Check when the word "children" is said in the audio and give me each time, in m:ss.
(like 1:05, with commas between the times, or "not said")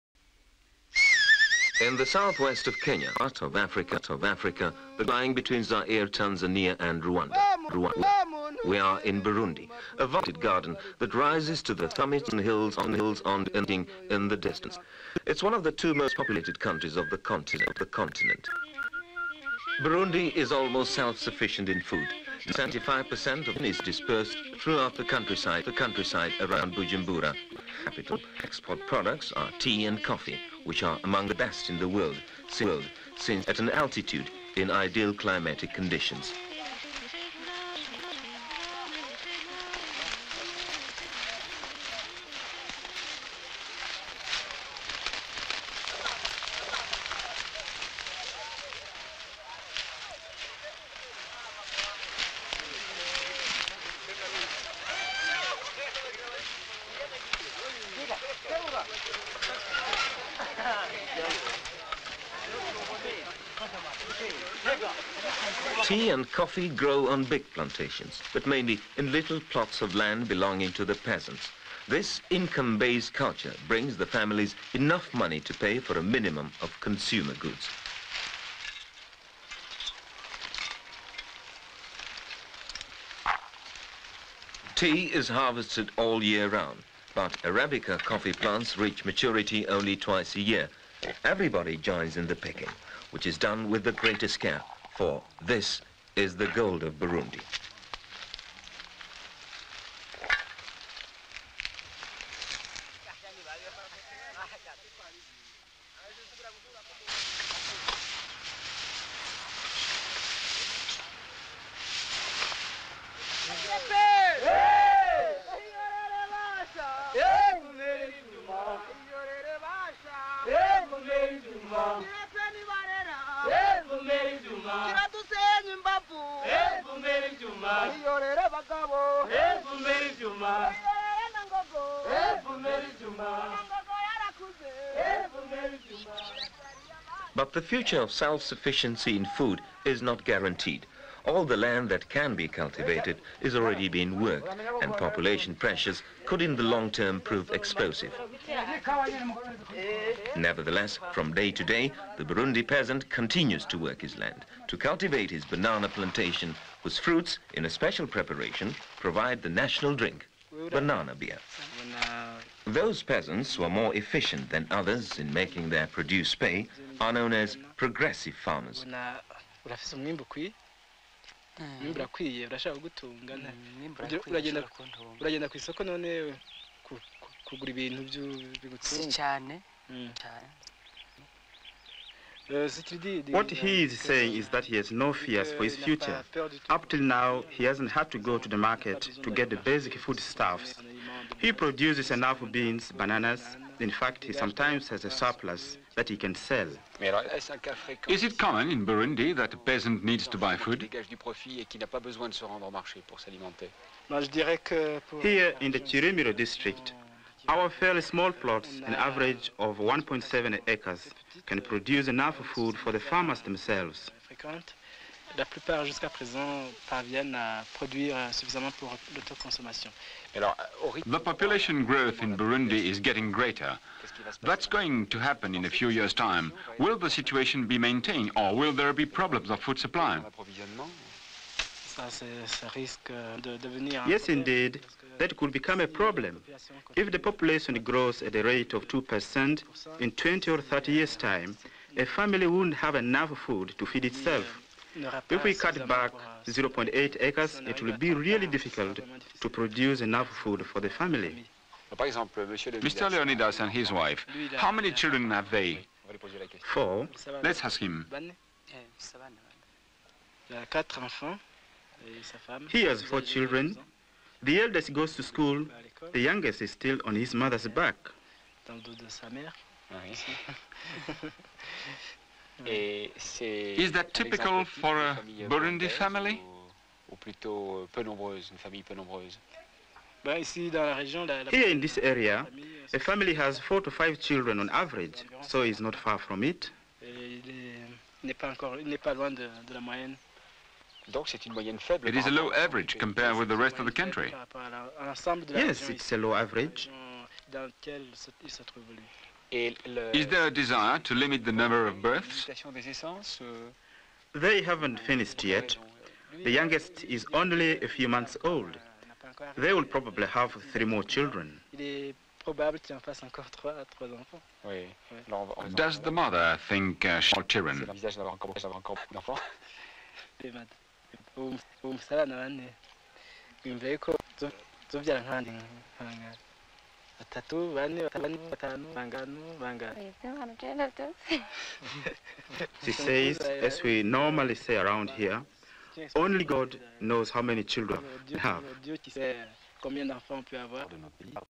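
4:14, 4:23, 4:44, 5:11, 5:17, 5:37.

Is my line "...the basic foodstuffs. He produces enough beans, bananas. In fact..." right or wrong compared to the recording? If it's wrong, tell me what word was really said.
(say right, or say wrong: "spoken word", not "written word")
right.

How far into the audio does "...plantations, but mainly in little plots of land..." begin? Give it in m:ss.
1:07.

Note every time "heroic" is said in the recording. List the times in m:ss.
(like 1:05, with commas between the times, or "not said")
not said.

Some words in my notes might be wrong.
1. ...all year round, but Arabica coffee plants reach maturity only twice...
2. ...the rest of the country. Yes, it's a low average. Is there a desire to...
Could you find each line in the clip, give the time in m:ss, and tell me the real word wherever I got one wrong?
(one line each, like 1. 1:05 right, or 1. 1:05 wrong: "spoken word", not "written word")
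1. 1:25 right
2. 4:53 right.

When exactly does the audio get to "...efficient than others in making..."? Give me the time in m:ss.
2:43.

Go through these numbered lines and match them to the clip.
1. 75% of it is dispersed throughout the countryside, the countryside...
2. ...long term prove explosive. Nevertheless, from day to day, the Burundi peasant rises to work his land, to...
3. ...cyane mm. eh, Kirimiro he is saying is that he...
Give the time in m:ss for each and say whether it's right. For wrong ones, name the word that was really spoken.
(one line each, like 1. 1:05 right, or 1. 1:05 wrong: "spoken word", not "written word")
1. 0:22 right
2. 2:26 wrong: "continues", not "rises"
3. 2:59 wrong: "What", not "Kirimiro".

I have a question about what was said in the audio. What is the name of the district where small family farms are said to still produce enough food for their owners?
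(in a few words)
Kirimiro.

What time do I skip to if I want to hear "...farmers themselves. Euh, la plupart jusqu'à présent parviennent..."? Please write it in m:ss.
3:32.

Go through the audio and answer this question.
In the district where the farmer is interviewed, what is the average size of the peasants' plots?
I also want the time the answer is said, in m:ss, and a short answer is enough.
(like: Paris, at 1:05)
1.7 acres, at 3:29.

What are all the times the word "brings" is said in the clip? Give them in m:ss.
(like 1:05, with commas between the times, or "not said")
1:13.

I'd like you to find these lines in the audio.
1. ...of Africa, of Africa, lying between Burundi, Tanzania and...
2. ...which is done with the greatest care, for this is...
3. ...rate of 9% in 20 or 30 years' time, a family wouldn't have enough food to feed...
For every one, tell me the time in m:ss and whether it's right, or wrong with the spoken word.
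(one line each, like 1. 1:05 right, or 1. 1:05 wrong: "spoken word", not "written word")
1. 0:03 wrong: "Zaire", not "Burundi"
2. 1:33 right
3. 3:58 wrong: "2", not "9".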